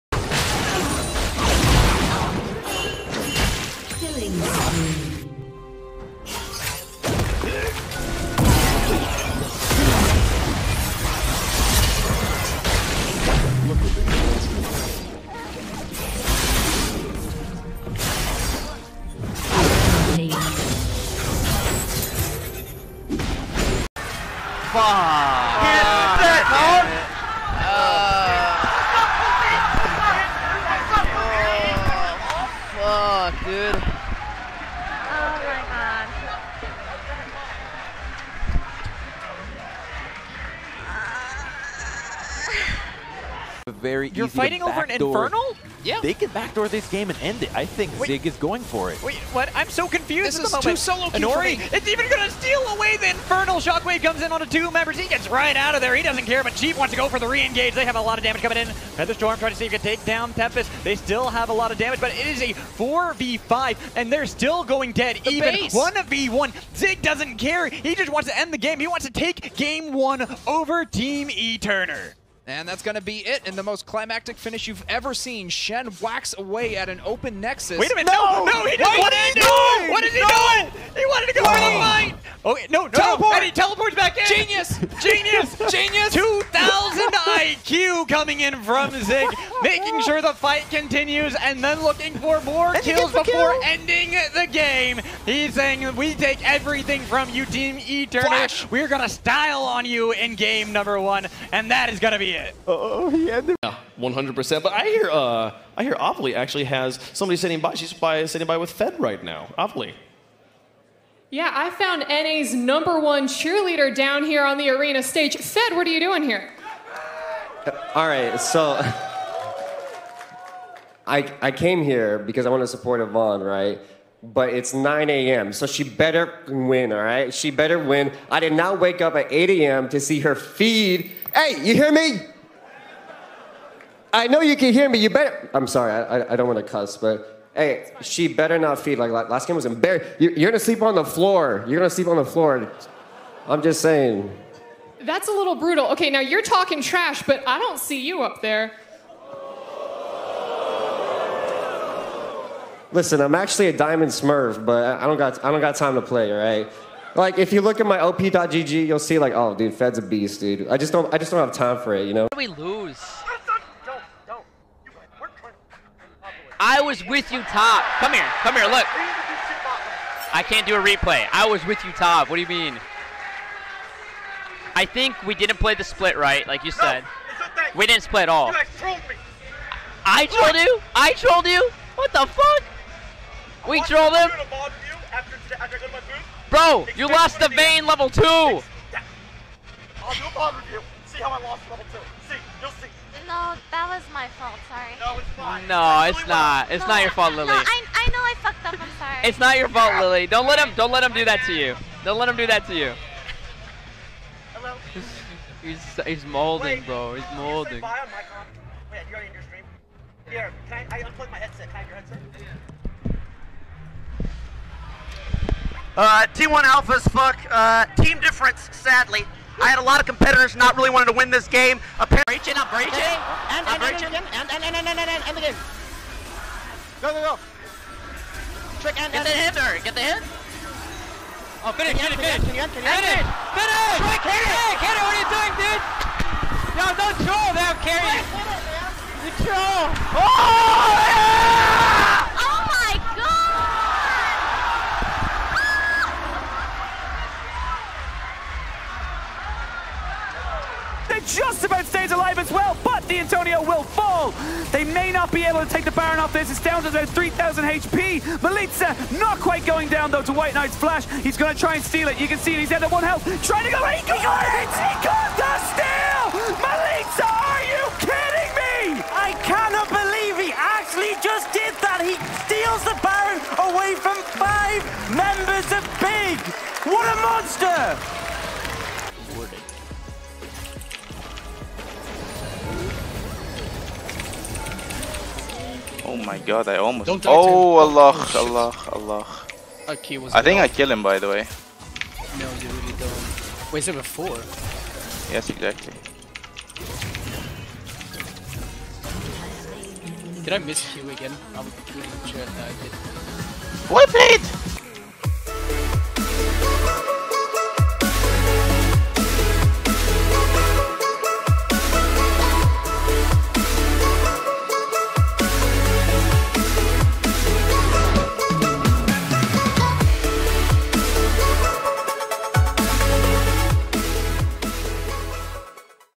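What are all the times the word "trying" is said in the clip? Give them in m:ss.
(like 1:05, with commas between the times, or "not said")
0:59, 4:23.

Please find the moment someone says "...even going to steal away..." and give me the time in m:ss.
0:51.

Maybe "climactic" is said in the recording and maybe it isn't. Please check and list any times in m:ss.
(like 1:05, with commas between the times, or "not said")
1:13.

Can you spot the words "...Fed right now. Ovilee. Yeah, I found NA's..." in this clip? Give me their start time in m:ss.
1:48.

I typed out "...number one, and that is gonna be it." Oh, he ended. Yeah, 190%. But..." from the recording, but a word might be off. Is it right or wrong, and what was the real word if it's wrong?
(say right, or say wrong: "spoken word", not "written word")
wrong: "100", not "190".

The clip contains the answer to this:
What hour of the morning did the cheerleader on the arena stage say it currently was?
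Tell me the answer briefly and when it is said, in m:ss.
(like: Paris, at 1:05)
9 a.m., at 2:04.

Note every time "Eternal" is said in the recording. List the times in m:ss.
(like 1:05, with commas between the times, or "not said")
1:11, 1:37.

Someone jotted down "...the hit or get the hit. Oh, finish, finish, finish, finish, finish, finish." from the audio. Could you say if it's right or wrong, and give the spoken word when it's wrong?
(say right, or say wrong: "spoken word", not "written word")
right.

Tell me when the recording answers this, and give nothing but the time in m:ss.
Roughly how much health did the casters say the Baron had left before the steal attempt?
4:17.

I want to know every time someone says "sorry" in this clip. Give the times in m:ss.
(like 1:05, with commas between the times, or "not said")
2:15, 3:14, 3:18.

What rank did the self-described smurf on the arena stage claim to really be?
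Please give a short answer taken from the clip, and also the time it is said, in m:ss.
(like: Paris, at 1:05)
Diamond, at 2:33.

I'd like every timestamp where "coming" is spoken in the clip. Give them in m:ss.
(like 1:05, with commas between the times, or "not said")
0:58, 1:28.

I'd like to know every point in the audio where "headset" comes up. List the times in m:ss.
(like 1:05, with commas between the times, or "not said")
3:31, 3:35.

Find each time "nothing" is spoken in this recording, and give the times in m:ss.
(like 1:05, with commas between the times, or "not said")
not said.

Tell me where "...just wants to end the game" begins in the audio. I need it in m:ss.
1:07.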